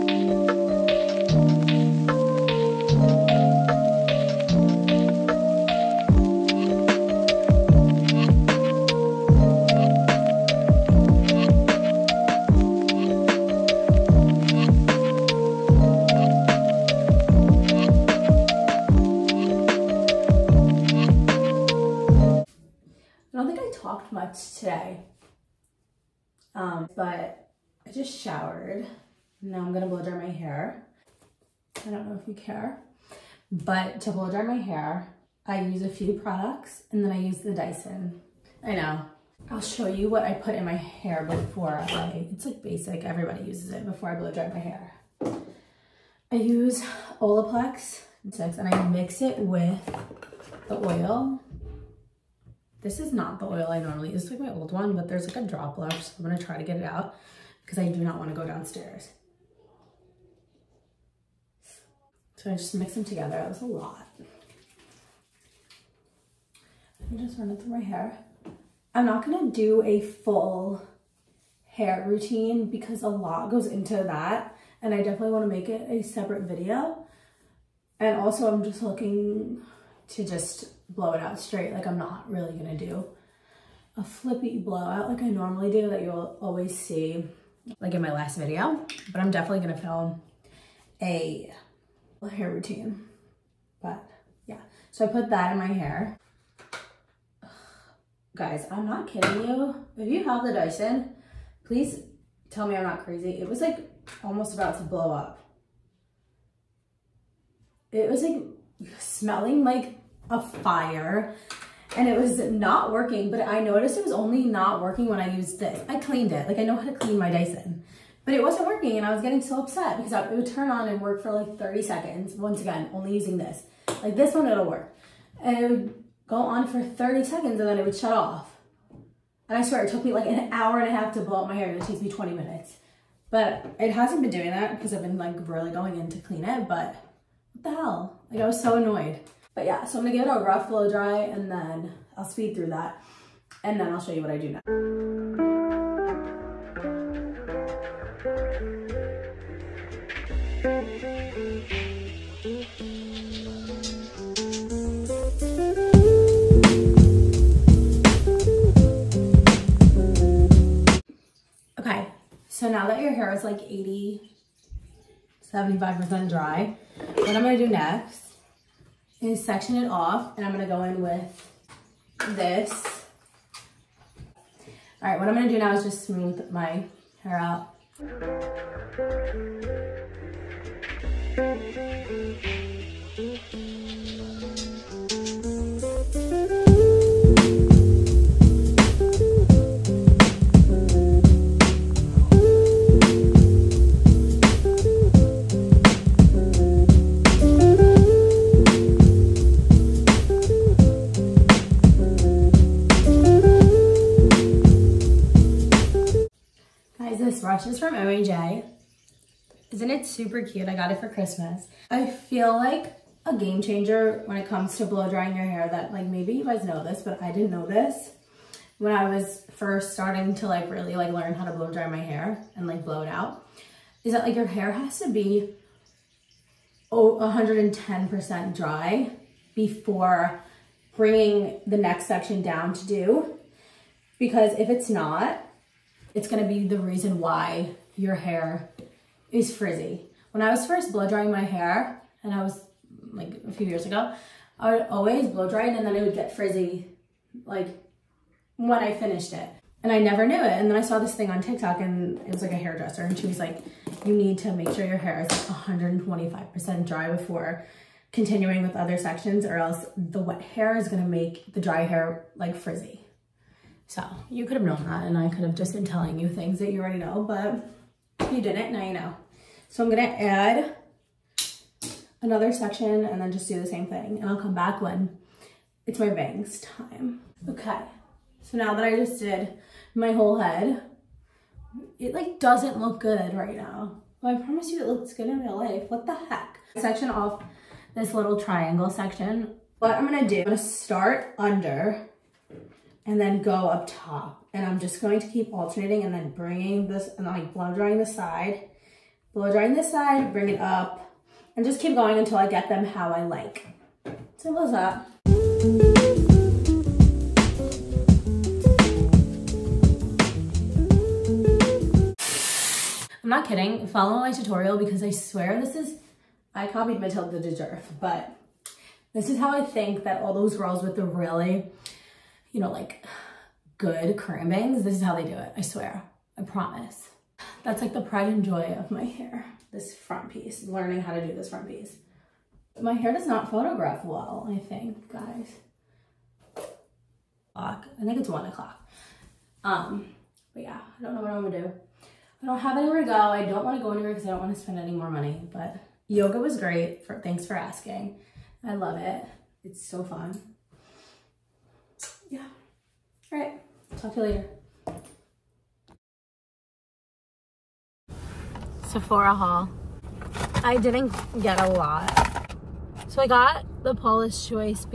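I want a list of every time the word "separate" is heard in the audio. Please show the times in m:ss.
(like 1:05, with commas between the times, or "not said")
1:16.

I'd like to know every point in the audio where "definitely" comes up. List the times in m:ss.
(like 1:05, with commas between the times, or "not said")
1:14, 1:29.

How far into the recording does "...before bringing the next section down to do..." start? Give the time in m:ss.
3:49.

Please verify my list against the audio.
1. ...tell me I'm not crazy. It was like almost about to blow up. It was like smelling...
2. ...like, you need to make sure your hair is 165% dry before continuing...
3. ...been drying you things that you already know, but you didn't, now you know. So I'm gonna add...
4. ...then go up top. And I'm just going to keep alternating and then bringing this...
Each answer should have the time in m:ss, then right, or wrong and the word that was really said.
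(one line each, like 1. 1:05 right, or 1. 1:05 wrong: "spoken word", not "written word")
1. 1:42 right
2. 4:13 wrong: "125", not "165"
3. 4:25 wrong: "telling", not "drying"
4. 4:53 right.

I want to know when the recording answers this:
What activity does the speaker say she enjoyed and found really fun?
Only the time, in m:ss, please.
5:46.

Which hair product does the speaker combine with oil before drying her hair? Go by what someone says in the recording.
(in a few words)
Olaplex.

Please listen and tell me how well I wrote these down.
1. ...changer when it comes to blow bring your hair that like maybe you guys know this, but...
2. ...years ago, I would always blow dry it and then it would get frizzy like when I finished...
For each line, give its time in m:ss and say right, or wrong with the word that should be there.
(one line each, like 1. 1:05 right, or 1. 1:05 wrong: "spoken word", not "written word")
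1. 3:33 wrong: "drying", not "bring"
2. 4:03 right.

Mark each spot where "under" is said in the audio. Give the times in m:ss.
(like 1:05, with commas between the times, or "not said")
4:51.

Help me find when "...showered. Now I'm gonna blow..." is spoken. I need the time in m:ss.
0:28.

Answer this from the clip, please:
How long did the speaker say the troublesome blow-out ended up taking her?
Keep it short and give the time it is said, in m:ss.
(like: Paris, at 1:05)
an hour and a half, at 2:10.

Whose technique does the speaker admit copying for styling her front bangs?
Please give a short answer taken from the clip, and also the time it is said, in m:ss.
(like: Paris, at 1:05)
Matilda Djerf, at 5:17.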